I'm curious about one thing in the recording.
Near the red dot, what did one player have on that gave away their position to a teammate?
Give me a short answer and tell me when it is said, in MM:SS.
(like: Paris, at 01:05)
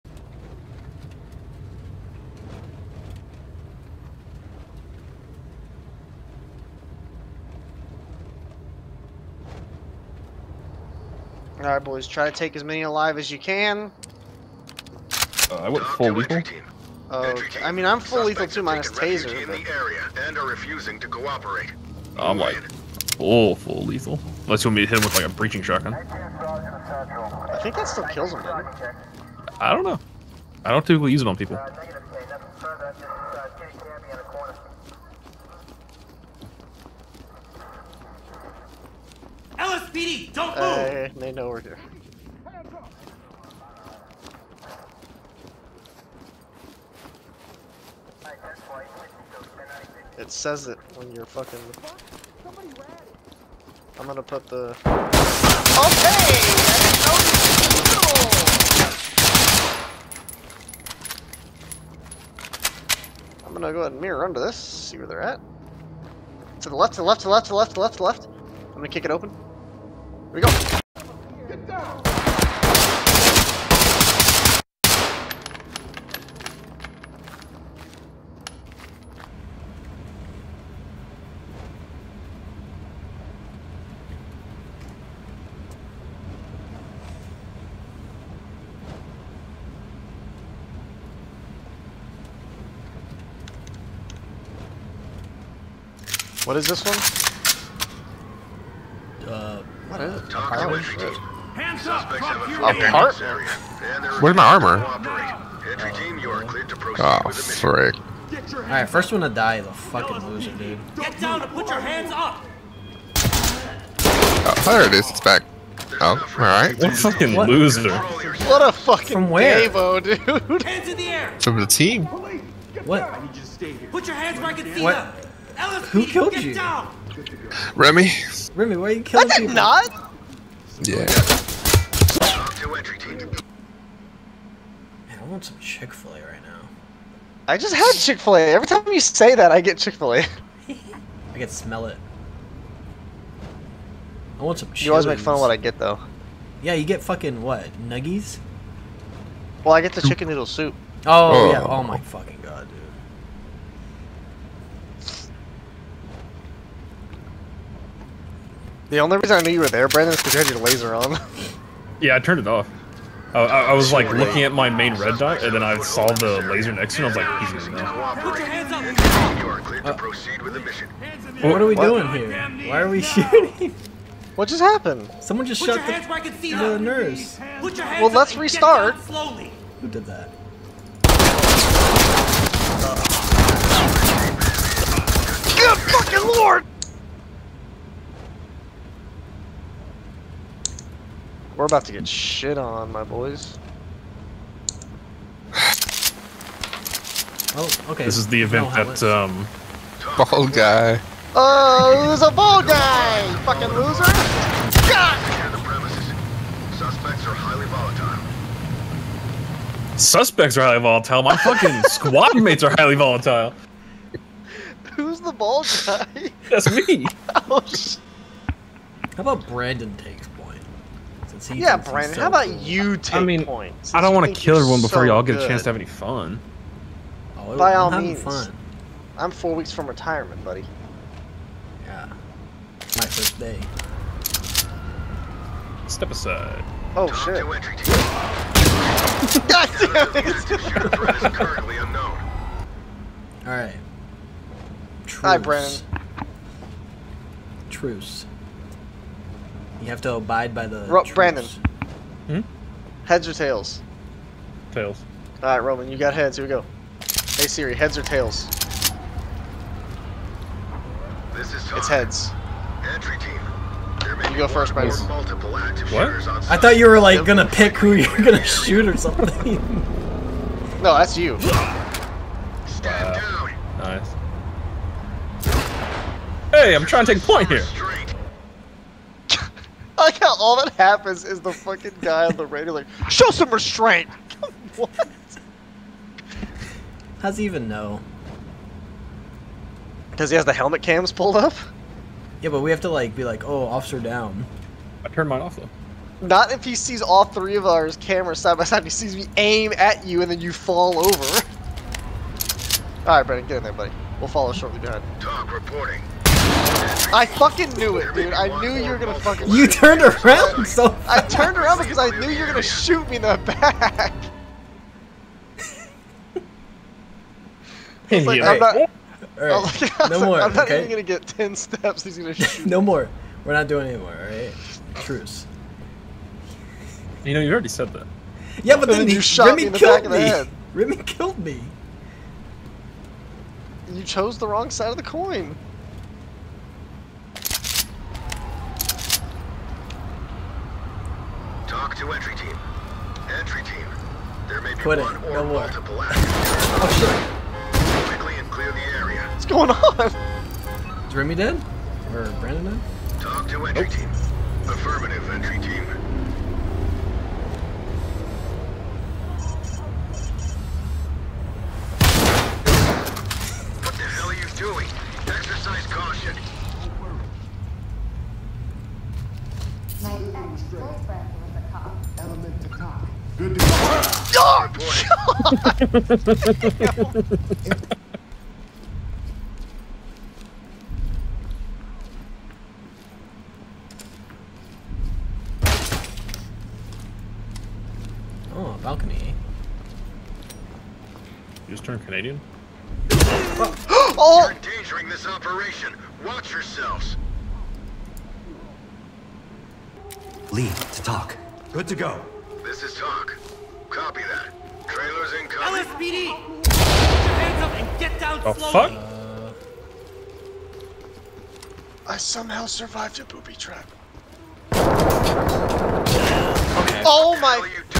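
laser on, at 02:40.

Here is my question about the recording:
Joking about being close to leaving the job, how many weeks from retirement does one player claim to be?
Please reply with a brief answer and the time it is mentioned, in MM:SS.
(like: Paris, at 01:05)
4, at 03:49.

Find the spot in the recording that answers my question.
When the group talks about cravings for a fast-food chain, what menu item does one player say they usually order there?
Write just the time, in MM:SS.
02:30.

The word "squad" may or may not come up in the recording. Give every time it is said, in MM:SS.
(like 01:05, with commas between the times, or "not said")
03:31.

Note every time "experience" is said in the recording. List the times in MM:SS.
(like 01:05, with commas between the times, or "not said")
not said.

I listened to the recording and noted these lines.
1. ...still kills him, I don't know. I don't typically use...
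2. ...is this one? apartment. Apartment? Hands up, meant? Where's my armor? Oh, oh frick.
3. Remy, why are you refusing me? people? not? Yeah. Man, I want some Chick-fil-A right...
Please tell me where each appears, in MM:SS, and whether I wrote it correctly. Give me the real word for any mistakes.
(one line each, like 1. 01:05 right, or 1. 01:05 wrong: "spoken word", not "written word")
1. 00:27 right
2. 01:36 wrong: "apartment", not "meant"
3. 02:08 wrong: "killing", not "refusing".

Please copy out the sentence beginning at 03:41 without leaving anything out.
Yeah, Brandon, how about you take I mean, points?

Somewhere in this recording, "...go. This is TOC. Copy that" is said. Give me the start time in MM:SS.
06:41.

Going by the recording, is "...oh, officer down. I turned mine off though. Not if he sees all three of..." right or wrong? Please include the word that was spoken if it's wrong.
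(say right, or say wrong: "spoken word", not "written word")
right.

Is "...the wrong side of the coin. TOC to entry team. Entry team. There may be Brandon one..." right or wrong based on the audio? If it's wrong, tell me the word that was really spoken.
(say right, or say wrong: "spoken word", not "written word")
wrong: "Quit", not "Brandon".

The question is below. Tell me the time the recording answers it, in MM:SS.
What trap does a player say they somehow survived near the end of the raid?
06:53.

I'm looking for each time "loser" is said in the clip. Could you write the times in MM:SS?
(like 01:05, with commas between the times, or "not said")
01:50, 01:57, 03:23.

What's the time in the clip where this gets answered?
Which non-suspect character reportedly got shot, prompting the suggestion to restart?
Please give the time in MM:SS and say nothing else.
02:56.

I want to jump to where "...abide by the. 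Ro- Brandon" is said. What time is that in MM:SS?
04:10.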